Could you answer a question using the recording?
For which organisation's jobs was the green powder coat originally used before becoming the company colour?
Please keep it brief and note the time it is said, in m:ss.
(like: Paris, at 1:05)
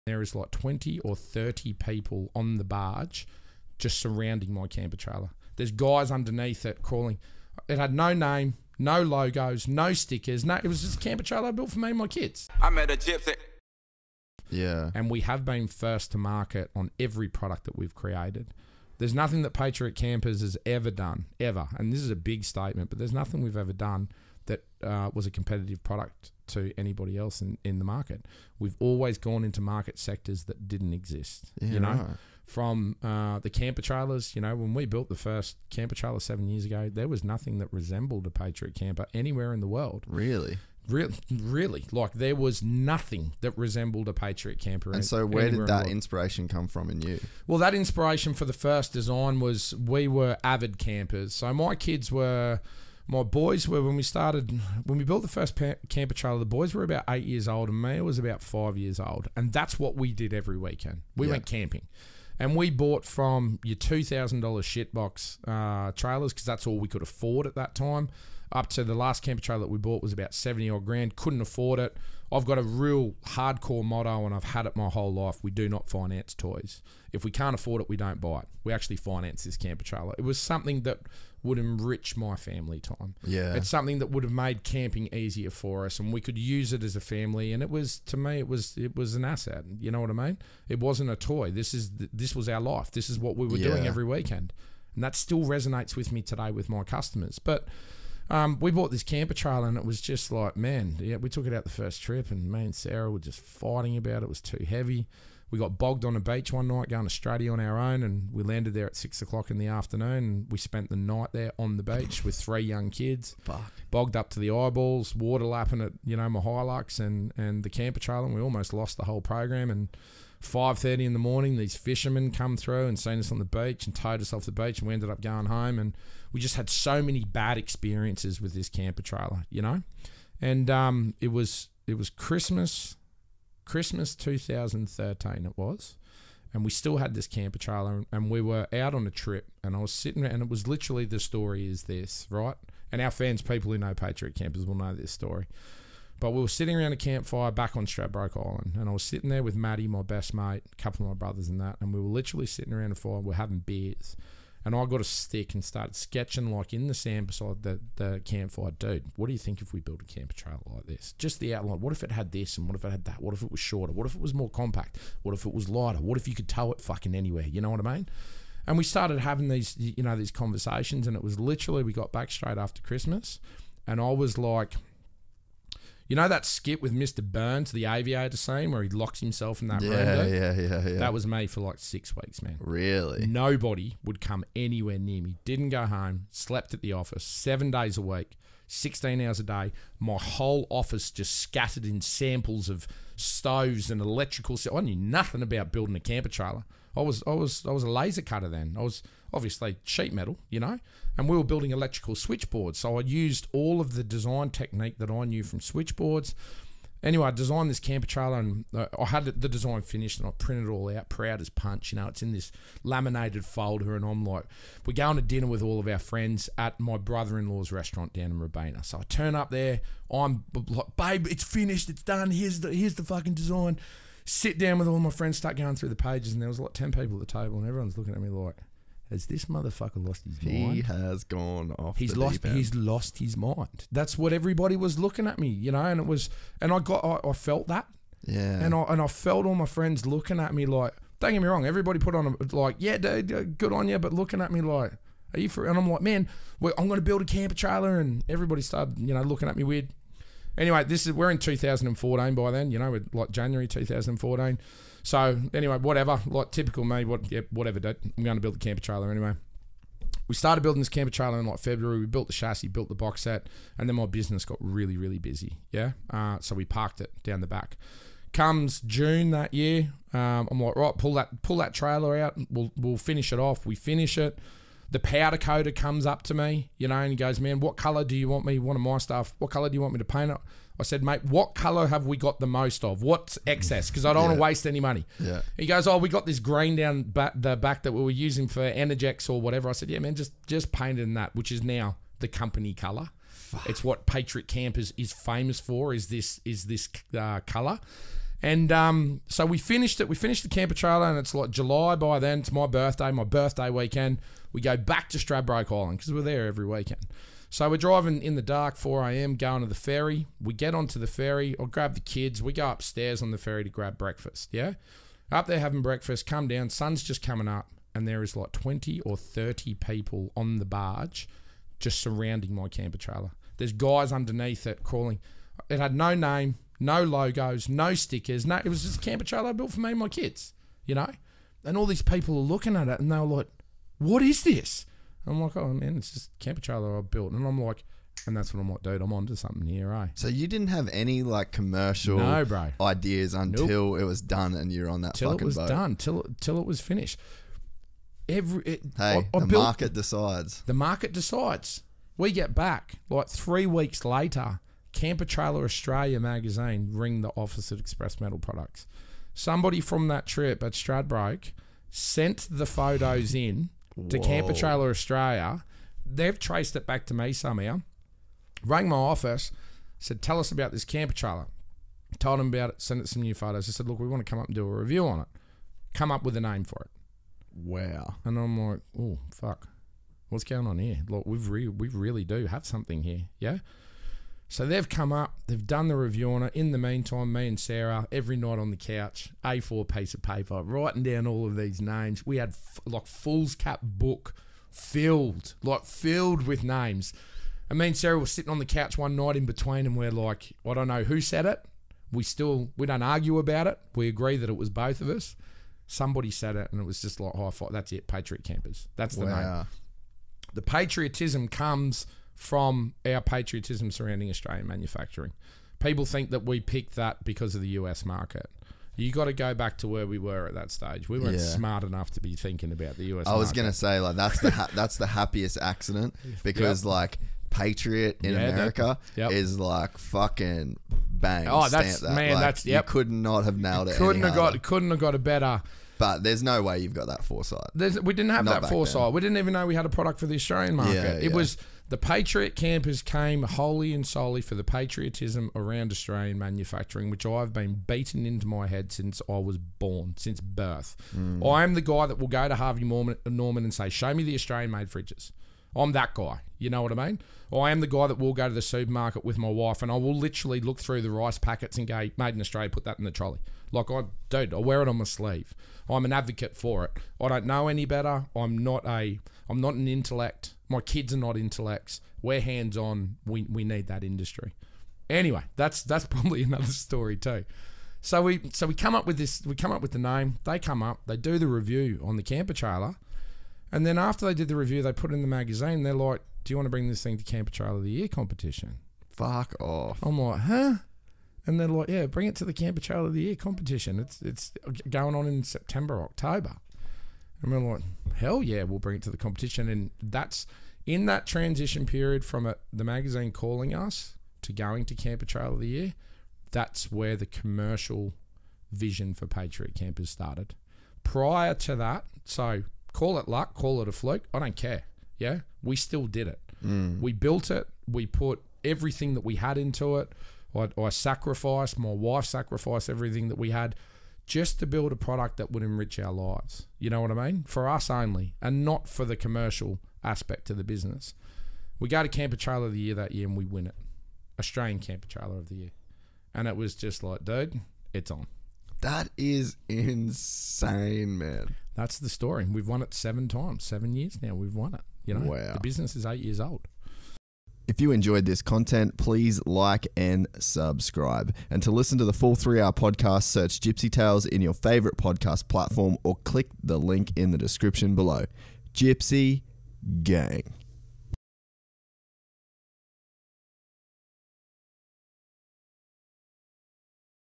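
Energex, at 4:48.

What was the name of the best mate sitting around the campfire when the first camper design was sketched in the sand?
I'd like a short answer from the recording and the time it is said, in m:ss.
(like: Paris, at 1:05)
Maddie, at 2:29.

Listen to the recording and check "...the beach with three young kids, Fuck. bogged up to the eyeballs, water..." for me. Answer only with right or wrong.
right.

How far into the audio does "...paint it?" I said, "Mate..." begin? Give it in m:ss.
4:40.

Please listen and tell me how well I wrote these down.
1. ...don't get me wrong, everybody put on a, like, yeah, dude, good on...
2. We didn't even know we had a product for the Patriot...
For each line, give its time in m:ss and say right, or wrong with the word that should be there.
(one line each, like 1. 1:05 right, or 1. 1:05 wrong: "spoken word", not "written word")
1. 4:01 right
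2. 7:19 wrong: "Australian", not "Patriot".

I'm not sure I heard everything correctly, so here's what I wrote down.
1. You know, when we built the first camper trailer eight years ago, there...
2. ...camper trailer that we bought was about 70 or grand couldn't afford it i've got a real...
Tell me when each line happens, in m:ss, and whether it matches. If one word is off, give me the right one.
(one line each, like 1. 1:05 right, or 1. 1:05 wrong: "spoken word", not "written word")
1. 0:34 wrong: "seven", not "eight"
2. 1:09 right.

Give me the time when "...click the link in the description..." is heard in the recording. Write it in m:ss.
9:16.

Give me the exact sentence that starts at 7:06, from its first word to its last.
like patriot in yeah, America yep.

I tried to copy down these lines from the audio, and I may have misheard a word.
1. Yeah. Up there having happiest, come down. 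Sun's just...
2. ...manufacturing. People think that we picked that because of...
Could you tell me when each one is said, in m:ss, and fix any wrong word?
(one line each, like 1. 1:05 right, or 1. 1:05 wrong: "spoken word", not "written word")
1. 5:14 wrong: "breakfast", not "happiest"
2. 6:54 right.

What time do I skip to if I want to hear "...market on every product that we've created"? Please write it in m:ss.
0:16.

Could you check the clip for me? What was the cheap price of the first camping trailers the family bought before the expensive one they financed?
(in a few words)
$2000.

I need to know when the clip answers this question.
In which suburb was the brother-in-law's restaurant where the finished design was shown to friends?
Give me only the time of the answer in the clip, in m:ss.
3:38.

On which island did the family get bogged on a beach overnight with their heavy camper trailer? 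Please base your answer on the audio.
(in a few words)
Straddie.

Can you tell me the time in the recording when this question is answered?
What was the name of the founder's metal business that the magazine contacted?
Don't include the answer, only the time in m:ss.
5:57.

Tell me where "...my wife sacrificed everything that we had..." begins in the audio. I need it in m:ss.
8:41.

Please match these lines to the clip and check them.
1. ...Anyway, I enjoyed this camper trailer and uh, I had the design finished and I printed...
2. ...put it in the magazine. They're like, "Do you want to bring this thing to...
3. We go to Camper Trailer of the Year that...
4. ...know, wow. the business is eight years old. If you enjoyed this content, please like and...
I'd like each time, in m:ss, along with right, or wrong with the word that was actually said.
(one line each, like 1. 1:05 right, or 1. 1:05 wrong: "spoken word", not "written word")
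1. 3:27 wrong: "designed", not "enjoyed"
2. 8:04 right
3. 8:51 right
4. 9:05 right.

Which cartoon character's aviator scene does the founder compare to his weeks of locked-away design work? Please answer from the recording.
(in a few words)
Mr. Burns.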